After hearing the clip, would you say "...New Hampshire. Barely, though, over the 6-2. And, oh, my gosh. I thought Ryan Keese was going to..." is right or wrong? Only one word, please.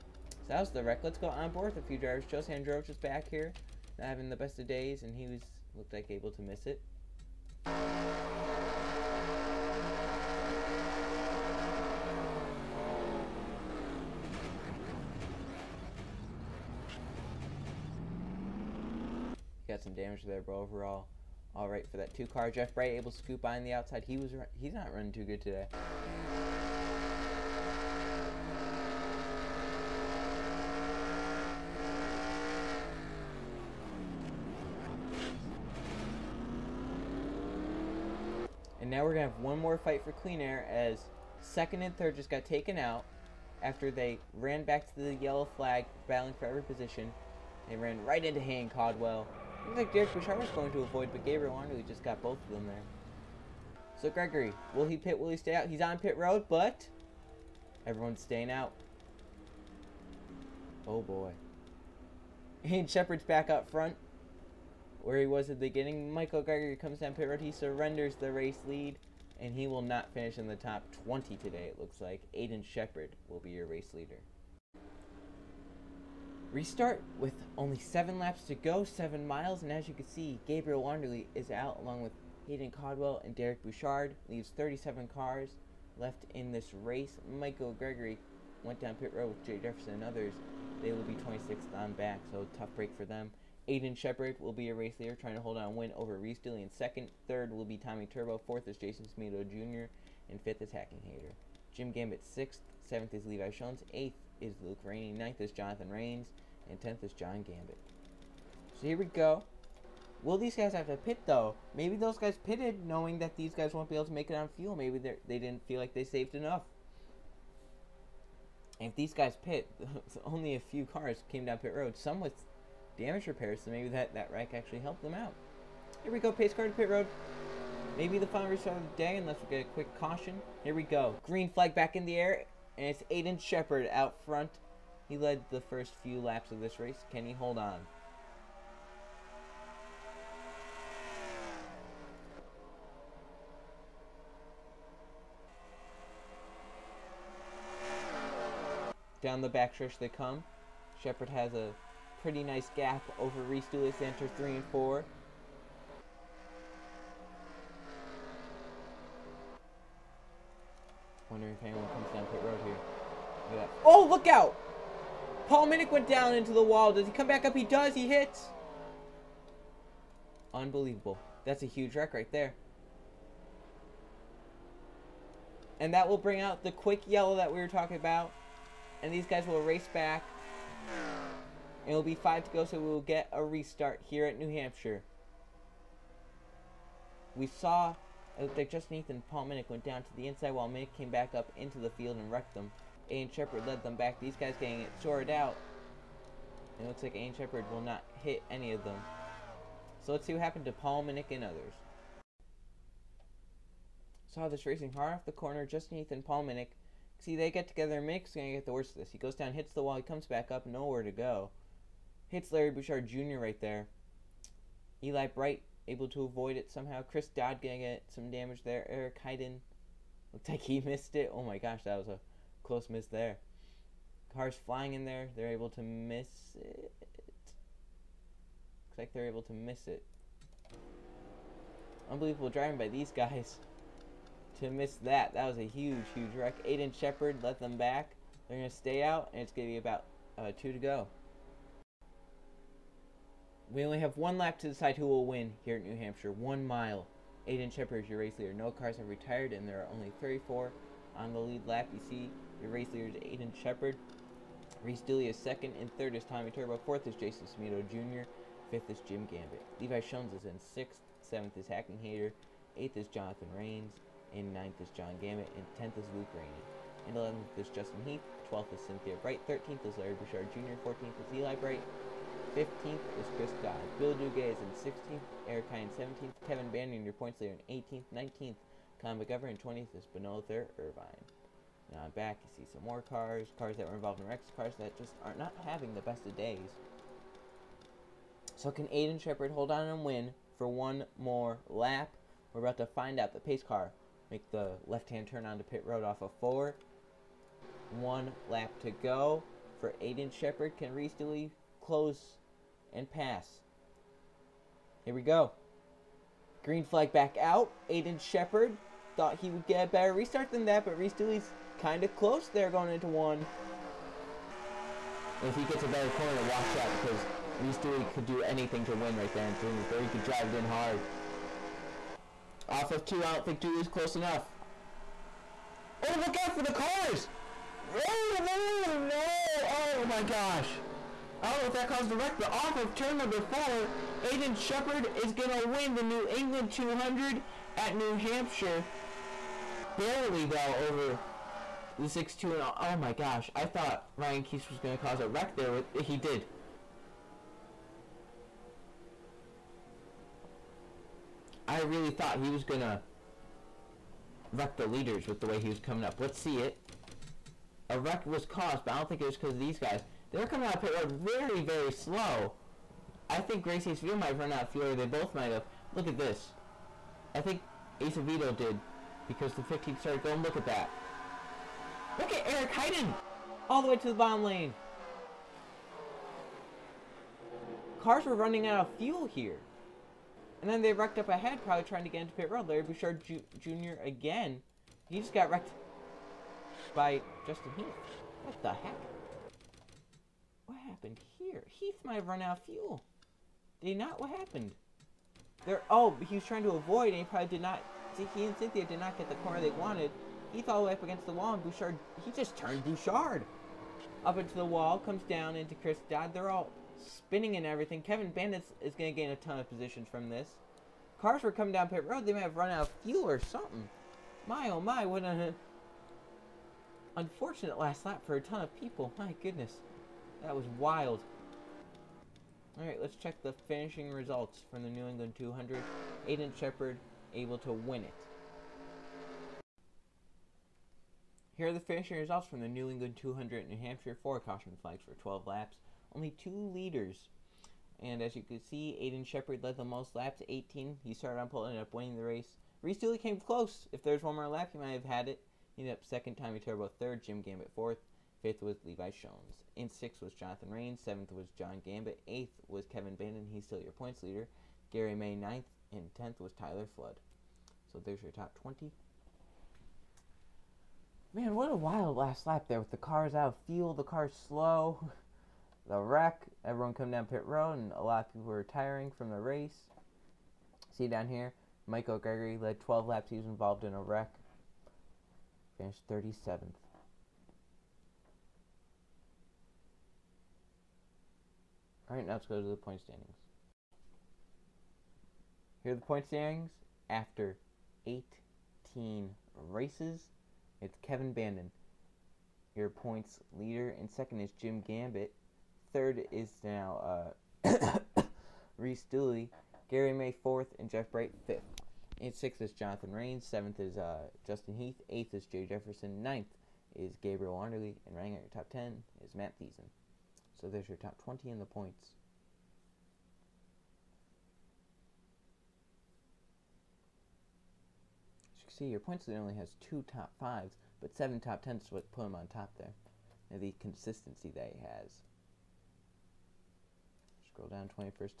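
right.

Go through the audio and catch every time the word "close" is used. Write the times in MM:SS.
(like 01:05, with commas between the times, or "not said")
03:42, 05:01, 05:12, 05:23, 07:23.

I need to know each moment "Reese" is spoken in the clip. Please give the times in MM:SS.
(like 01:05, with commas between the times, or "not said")
01:36, 02:33, 04:14, 05:00, 05:10, 05:17, 07:22, 08:18.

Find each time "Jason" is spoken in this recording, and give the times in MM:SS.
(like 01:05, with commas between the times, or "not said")
01:38, 04:17.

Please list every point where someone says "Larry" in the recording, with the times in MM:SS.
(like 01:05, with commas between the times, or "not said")
03:32, 04:29, 06:22.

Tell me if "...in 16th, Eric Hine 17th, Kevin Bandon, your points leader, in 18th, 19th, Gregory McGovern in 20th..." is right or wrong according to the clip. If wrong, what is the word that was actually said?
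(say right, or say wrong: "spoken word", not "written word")
wrong: "Colin", not "Gregory".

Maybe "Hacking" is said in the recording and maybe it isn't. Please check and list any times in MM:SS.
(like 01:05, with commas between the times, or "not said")
01:40, 04:21.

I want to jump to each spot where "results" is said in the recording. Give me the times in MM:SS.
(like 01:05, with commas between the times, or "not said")
07:04, 07:12.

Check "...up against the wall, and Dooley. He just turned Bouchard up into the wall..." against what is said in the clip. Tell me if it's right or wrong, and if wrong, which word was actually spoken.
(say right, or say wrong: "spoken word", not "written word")
wrong: "Bouchard", not "Dooley".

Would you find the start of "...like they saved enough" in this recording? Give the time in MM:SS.
01:55.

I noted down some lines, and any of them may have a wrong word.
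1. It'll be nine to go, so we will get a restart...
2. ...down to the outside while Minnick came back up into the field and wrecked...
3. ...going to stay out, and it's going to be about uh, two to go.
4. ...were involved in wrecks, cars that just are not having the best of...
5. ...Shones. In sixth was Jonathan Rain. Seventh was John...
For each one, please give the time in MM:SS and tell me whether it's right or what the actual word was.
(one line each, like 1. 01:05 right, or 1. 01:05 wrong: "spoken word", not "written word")
1. 03:01 wrong: "five", not "nine"
2. 03:09 wrong: "inside", not "outside"
3. 03:58 right
4. 04:43 right
5. 07:29 right.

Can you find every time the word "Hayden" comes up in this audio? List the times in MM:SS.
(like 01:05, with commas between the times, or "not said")
00:48, 01:22, 03:39, 06:12.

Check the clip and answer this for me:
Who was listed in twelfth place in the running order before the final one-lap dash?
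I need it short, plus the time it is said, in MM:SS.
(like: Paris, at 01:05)
Cynthia Bright, at 04:28.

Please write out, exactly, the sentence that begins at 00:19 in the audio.
Got some damage there, but overall, all right for that two car.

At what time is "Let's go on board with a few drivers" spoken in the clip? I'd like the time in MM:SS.
00:01.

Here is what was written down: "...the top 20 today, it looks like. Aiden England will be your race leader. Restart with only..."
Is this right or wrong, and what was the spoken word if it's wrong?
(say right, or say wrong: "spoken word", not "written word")
wrong: "Shepard", not "England".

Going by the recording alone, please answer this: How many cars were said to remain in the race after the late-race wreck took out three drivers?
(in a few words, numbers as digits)
37.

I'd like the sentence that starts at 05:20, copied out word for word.
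He could drive it in hard.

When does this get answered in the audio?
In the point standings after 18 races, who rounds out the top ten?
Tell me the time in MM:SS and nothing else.
08:29.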